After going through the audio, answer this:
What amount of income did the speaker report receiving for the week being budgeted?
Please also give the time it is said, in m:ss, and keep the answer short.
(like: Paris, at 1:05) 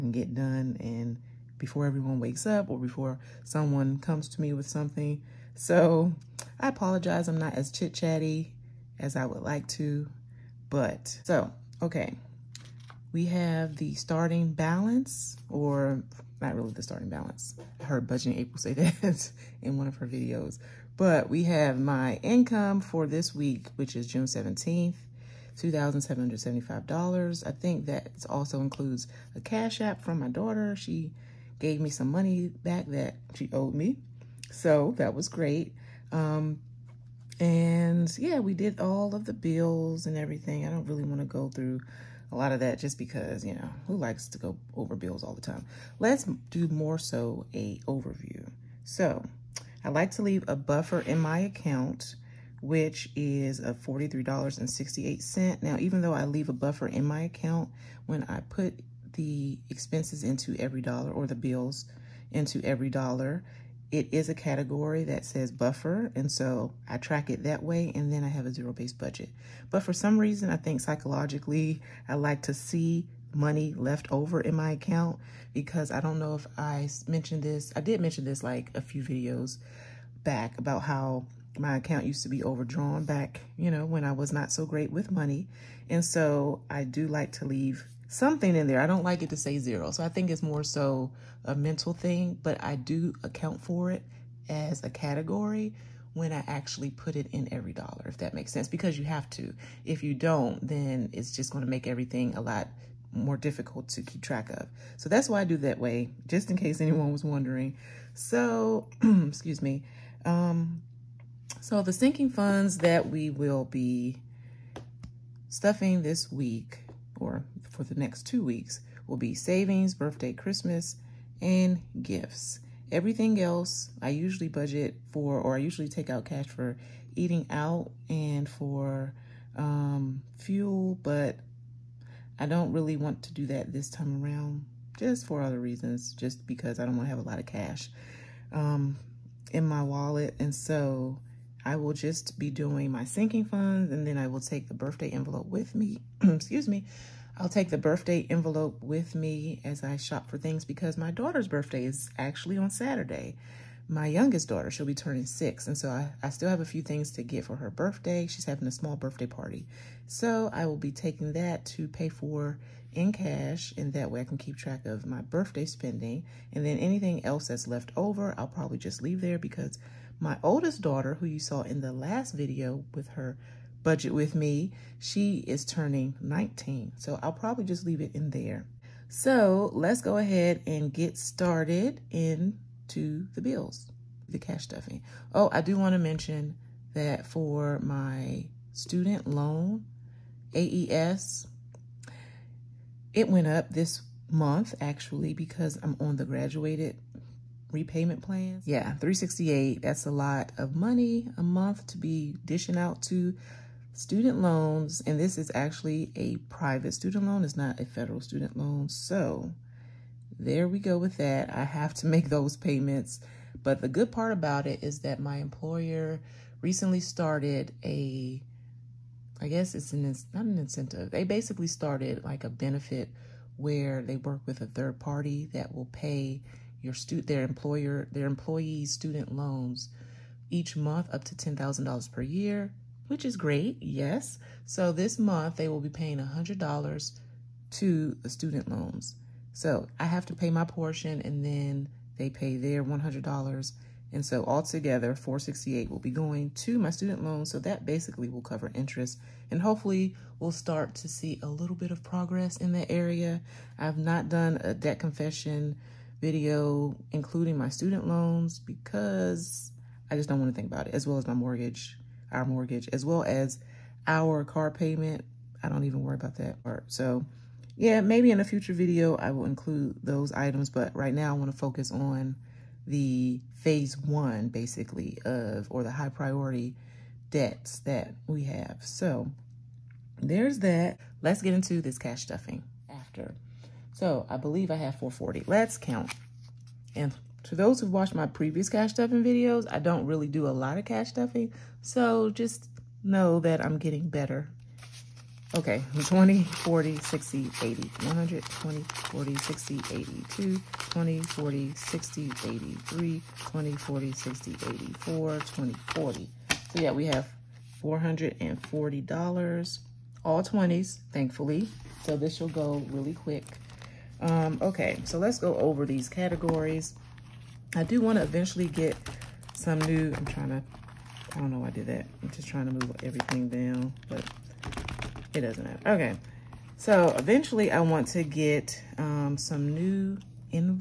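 $2,775, at 0:25.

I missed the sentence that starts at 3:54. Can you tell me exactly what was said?
So this month they will be paying $100 to the student loans.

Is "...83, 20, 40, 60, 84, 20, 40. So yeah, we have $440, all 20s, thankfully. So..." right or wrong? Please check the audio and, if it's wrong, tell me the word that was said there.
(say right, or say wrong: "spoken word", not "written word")
right.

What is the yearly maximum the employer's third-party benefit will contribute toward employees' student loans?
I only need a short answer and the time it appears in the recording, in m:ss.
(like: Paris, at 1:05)
$10,000, at 3:51.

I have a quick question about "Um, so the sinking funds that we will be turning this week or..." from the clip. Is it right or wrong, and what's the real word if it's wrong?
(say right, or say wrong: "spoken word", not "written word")
wrong: "stuffing", not "turning".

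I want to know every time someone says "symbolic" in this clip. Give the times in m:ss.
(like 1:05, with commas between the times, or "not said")
not said.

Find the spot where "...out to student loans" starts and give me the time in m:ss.
3:22.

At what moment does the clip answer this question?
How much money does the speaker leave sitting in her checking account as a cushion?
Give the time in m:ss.
0:53.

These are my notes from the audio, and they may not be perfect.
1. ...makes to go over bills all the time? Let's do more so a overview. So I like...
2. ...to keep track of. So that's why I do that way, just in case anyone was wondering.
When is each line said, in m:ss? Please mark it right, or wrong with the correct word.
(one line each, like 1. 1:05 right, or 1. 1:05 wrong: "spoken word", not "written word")
1. 0:43 wrong: "likes", not "makes"
2. 1:43 right.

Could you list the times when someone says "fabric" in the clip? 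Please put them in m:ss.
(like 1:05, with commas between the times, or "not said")
not said.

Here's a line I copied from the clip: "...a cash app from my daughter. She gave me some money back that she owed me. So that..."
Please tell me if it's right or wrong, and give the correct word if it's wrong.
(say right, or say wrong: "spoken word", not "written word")
right.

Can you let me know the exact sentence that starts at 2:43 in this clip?
And that way I can keep track of my birthday spending.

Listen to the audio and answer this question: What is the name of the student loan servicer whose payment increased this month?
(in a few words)
AES.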